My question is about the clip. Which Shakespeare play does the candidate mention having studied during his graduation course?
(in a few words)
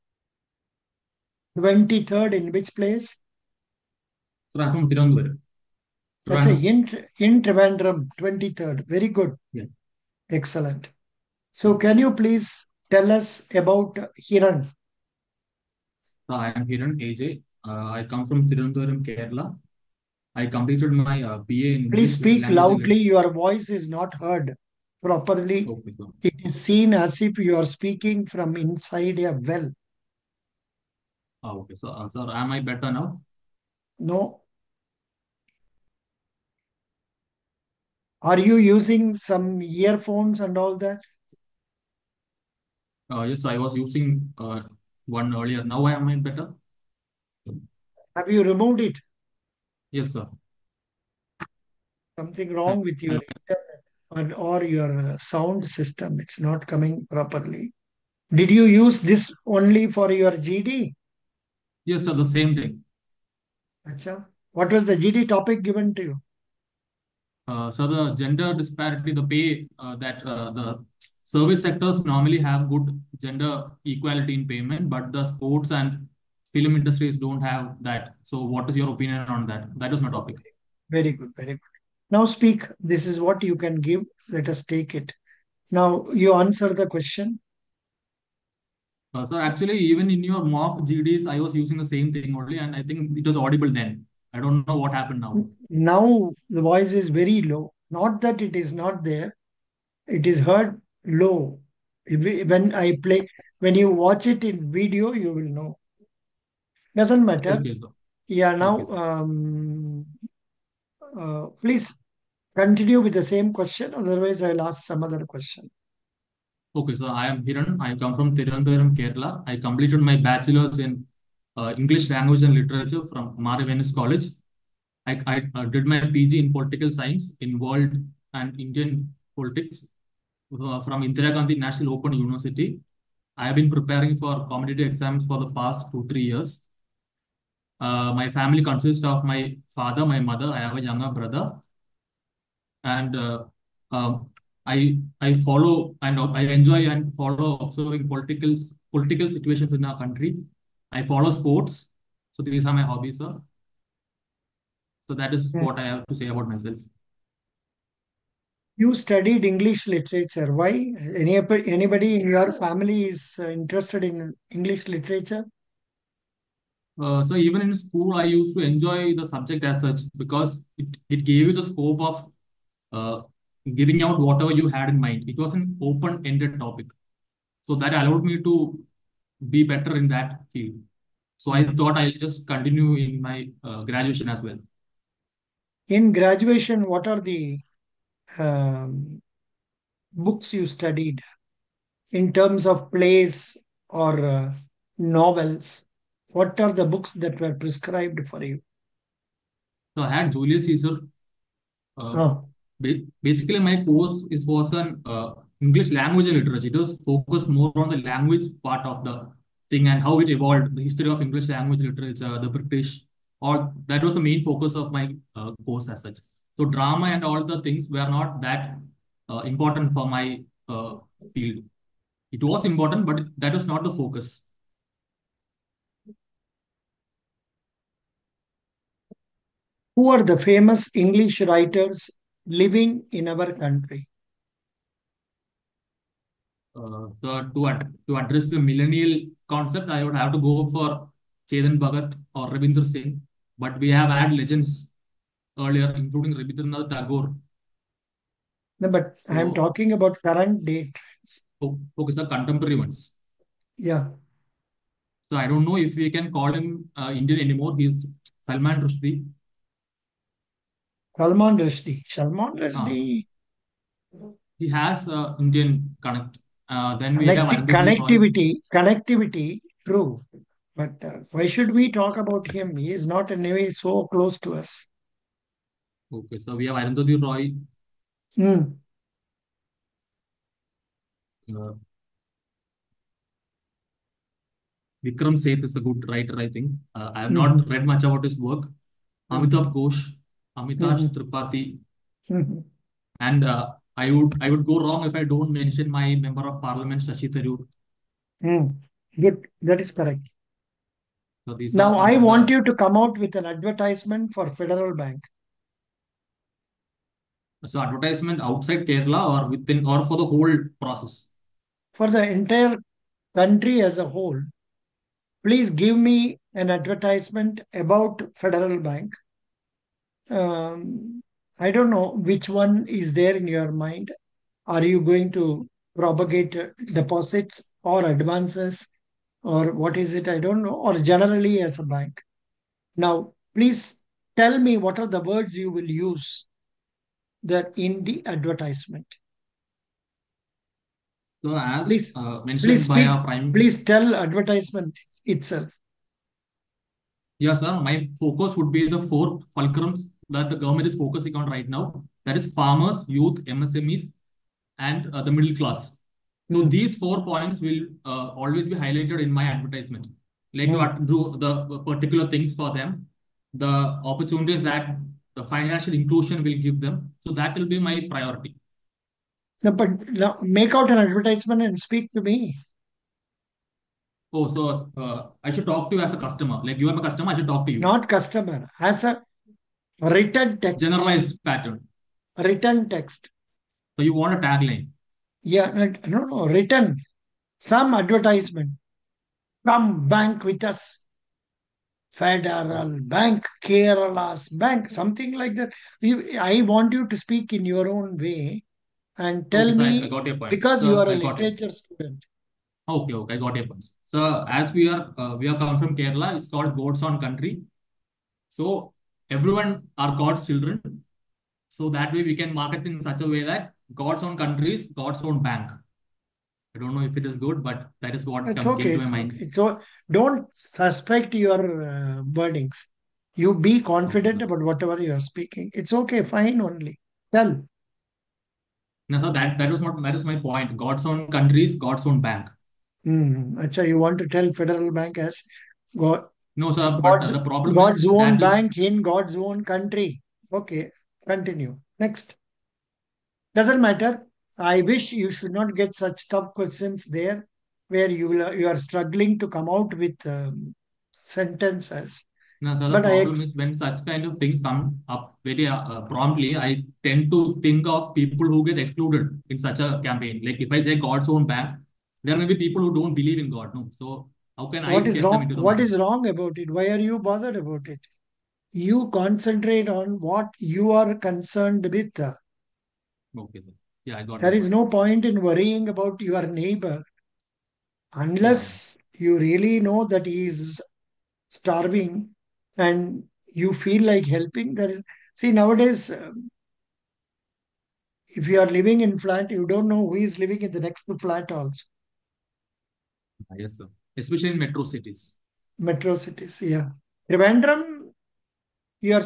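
Julius Caesar.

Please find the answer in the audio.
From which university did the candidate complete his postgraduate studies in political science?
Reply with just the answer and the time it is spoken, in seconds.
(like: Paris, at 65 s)
Indira Gandhi National Open University, at 131 s.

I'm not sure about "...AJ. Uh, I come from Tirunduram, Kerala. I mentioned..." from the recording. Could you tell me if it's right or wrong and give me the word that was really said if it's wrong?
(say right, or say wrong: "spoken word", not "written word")
wrong: "completed", not "mentioned".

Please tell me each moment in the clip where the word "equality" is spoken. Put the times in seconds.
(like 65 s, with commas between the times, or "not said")
73 s.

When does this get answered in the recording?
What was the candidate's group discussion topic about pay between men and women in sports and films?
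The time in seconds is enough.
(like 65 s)
68 s.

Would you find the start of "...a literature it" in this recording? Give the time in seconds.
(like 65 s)
401 s.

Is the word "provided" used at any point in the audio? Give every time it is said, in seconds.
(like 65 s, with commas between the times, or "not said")
not said.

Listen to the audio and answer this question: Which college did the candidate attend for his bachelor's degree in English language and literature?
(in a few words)
Mar Ivanios College.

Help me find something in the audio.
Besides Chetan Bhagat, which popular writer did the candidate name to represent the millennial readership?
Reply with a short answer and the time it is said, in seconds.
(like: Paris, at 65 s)
Ravinder Singh, at 242 s.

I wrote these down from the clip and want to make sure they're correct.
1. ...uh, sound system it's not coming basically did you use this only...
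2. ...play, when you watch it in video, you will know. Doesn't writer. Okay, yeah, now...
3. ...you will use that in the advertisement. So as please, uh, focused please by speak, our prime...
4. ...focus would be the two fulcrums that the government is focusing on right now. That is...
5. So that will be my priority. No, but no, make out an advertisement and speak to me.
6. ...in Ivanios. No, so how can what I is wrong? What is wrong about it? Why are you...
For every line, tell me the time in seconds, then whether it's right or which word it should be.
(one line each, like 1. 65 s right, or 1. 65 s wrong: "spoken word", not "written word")
1. 55 s wrong: "properly", not "basically"
2. 103 s wrong: "matter", not "writer"
3. 335 s wrong: "mentioned", not "focused"
4. 348 s wrong: "four", not "two"
5. 367 s right
6. 463 s wrong: "God", not "Ivanios".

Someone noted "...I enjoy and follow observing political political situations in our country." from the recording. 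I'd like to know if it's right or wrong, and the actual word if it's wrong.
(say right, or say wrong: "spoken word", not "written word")
right.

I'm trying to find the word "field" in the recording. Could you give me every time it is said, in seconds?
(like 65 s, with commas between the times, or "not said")
180 s, 221 s.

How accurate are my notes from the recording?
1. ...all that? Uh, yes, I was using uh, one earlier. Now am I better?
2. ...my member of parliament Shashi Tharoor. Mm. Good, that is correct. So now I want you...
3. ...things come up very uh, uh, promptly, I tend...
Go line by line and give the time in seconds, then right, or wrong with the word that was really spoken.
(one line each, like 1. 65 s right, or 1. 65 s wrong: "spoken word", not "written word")
1. 40 s right
2. 295 s right
3. 454 s right.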